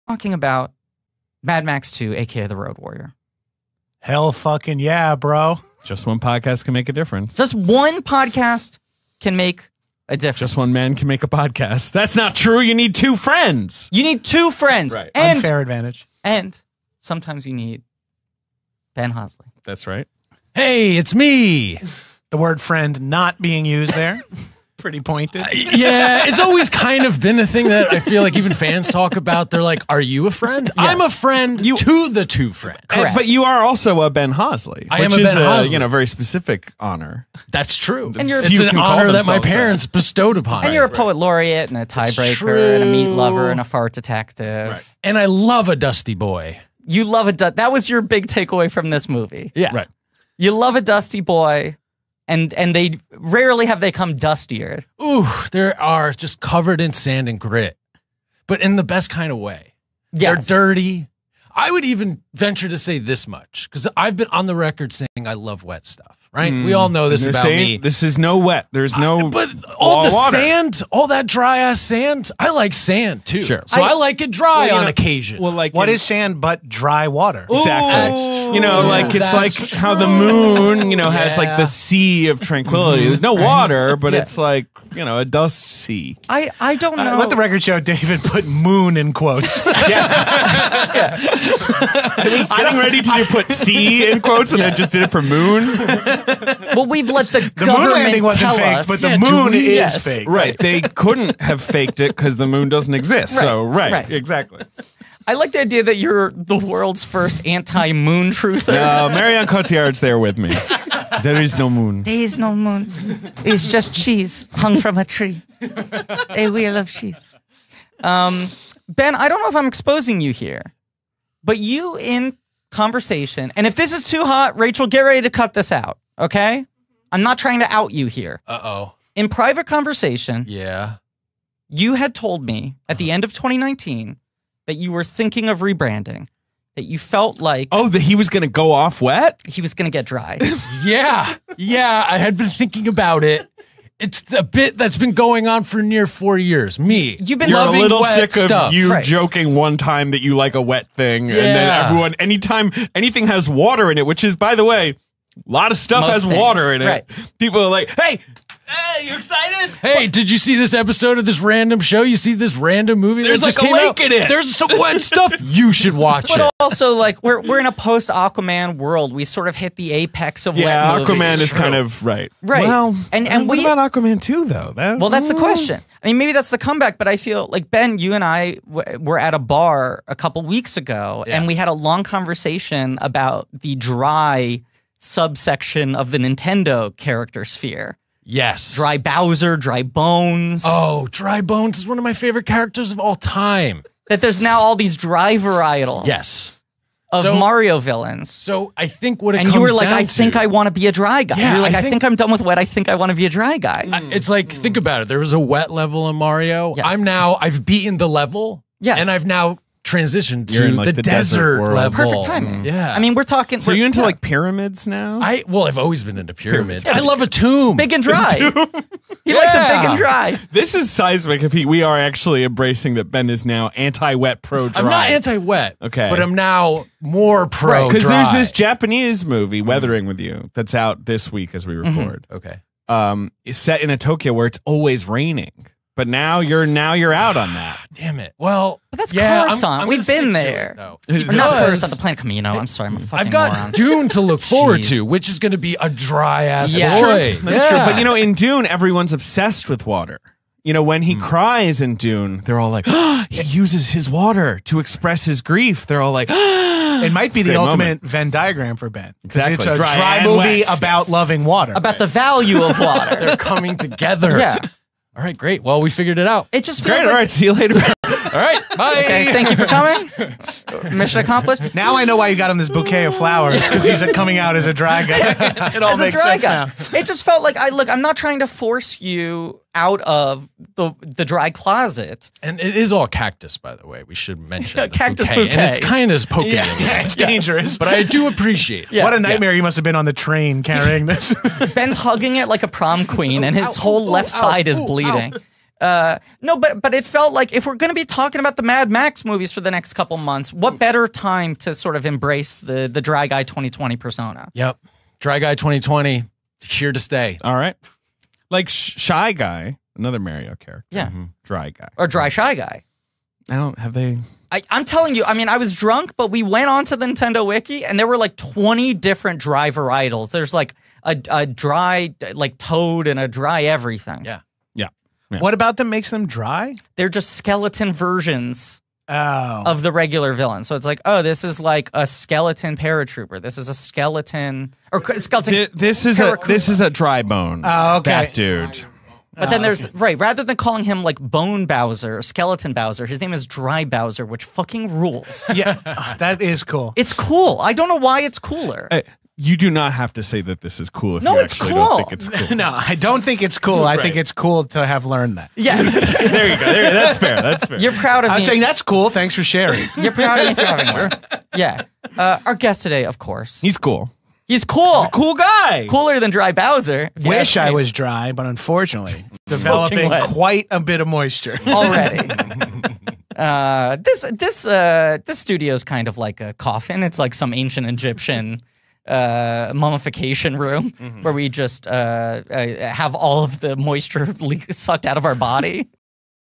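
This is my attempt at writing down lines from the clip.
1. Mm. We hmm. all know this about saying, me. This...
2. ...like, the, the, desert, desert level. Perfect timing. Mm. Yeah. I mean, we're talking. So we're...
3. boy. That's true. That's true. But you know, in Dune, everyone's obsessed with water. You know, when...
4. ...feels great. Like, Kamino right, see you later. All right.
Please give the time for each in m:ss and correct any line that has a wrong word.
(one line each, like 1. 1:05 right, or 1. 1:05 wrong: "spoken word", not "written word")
1. 1:06 right
2. 3:30 right
3. 4:07 right
4. 4:26 wrong: "All", not "Kamino".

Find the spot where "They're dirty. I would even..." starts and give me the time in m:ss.
1:00.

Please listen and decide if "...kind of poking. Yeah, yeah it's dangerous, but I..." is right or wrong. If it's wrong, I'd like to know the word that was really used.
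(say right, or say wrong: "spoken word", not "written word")
right.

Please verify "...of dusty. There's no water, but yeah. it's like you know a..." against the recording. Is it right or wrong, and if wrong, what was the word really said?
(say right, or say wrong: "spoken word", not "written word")
wrong: "tranquility", not "dusty".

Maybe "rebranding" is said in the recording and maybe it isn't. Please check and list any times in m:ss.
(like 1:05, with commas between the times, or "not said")
2:15.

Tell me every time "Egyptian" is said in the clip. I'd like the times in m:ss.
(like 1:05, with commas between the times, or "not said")
6:17.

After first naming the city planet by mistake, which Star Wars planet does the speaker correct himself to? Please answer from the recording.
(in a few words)
Kamino.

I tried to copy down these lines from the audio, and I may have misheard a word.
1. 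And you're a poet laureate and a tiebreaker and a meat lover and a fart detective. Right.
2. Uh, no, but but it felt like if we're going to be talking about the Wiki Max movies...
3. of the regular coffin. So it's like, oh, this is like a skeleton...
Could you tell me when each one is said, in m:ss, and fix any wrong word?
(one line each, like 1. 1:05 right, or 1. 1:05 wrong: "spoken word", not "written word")
1. 0:40 right
2. 4:55 wrong: "Mad", not "Wiki"
3. 5:29 wrong: "villain", not "coffin".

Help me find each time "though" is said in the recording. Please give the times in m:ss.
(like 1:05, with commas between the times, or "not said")
2:54, 4:00.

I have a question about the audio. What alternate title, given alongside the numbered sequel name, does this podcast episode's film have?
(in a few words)
The Road Warrior.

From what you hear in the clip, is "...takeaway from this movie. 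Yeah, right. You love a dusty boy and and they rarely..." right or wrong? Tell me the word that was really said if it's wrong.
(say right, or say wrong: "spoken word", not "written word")
right.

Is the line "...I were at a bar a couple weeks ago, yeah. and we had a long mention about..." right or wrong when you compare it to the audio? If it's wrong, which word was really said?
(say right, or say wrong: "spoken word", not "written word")
wrong: "conversation", not "mention".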